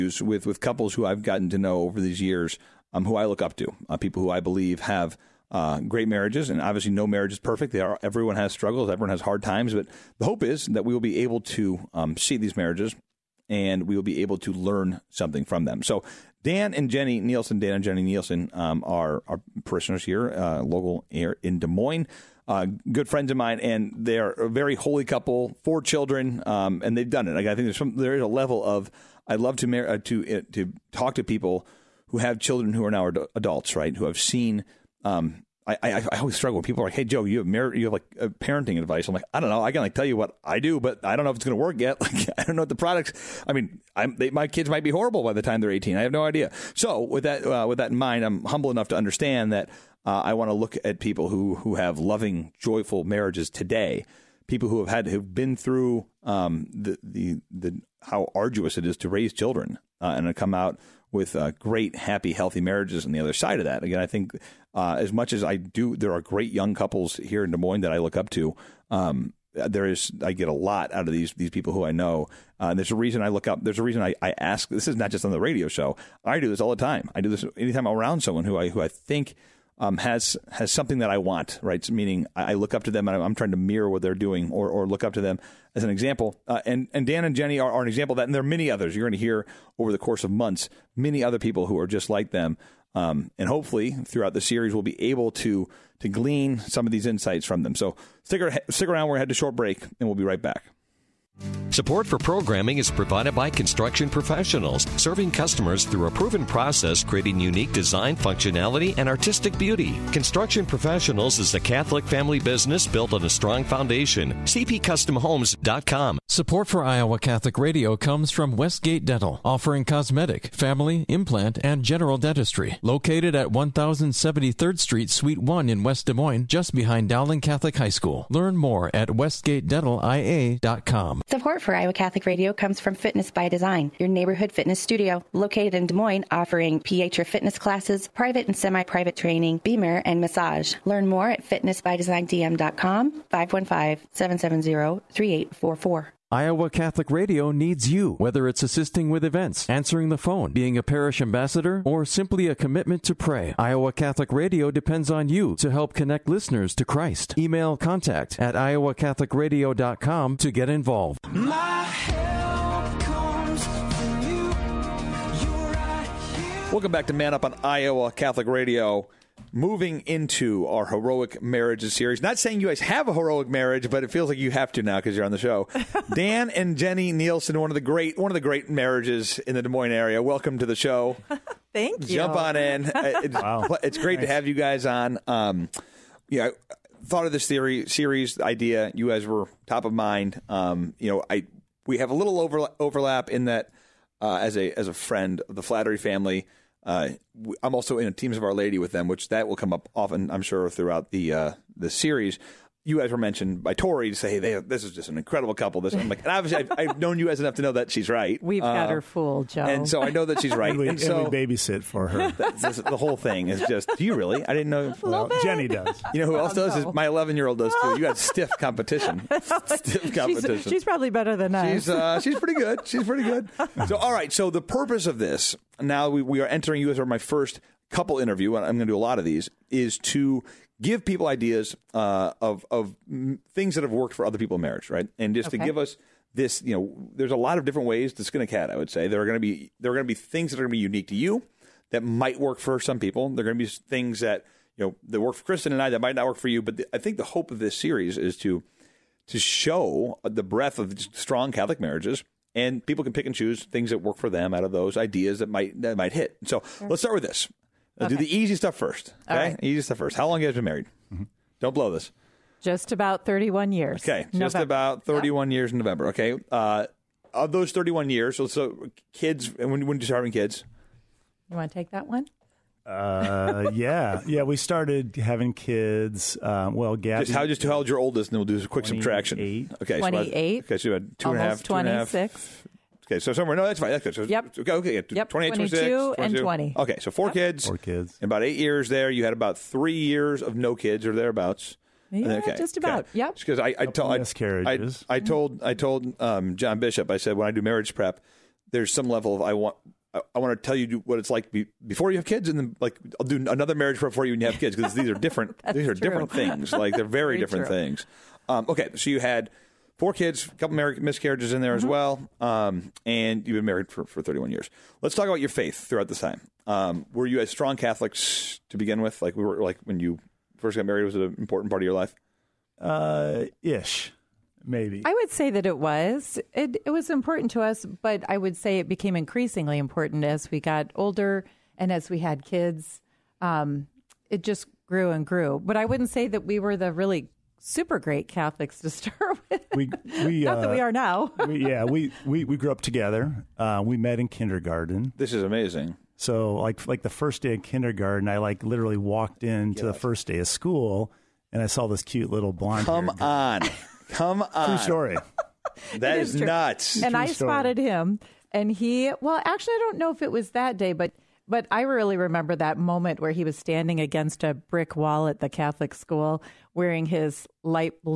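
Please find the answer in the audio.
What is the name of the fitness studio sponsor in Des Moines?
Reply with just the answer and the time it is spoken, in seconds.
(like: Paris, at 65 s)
Fitness by Design, at 132 s.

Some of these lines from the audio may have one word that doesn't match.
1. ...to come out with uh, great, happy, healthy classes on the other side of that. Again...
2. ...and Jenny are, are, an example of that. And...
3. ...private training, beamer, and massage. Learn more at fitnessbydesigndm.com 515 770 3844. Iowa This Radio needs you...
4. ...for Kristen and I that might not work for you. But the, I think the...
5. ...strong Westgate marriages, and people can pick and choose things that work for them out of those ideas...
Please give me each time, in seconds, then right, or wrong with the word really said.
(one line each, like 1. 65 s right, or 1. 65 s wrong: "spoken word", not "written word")
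1. 60 s wrong: "marriages", not "classes"
2. 87 s right
3. 138 s wrong: "Catholic", not "This"
4. 245 s right
5. 250 s wrong: "Catholic", not "Westgate".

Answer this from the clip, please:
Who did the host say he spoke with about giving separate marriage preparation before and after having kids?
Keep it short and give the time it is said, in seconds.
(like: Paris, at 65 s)
John Bishop, at 296 s.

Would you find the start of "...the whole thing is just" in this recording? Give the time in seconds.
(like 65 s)
212 s.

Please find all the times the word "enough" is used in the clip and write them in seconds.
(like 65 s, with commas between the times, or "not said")
48 s, 207 s.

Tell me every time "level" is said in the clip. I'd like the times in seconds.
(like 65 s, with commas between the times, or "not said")
28 s, 299 s.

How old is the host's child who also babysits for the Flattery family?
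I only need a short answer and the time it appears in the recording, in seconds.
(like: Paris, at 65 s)
11, at 217 s.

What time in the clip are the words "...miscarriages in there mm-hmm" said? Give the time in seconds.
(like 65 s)
310 s.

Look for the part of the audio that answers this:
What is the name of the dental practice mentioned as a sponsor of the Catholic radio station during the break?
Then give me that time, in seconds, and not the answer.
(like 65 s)
118 s.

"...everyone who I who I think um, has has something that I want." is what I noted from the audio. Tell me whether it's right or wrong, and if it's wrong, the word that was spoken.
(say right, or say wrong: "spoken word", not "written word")
wrong: "someone", not "everyone".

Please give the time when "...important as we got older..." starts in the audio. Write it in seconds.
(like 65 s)
329 s.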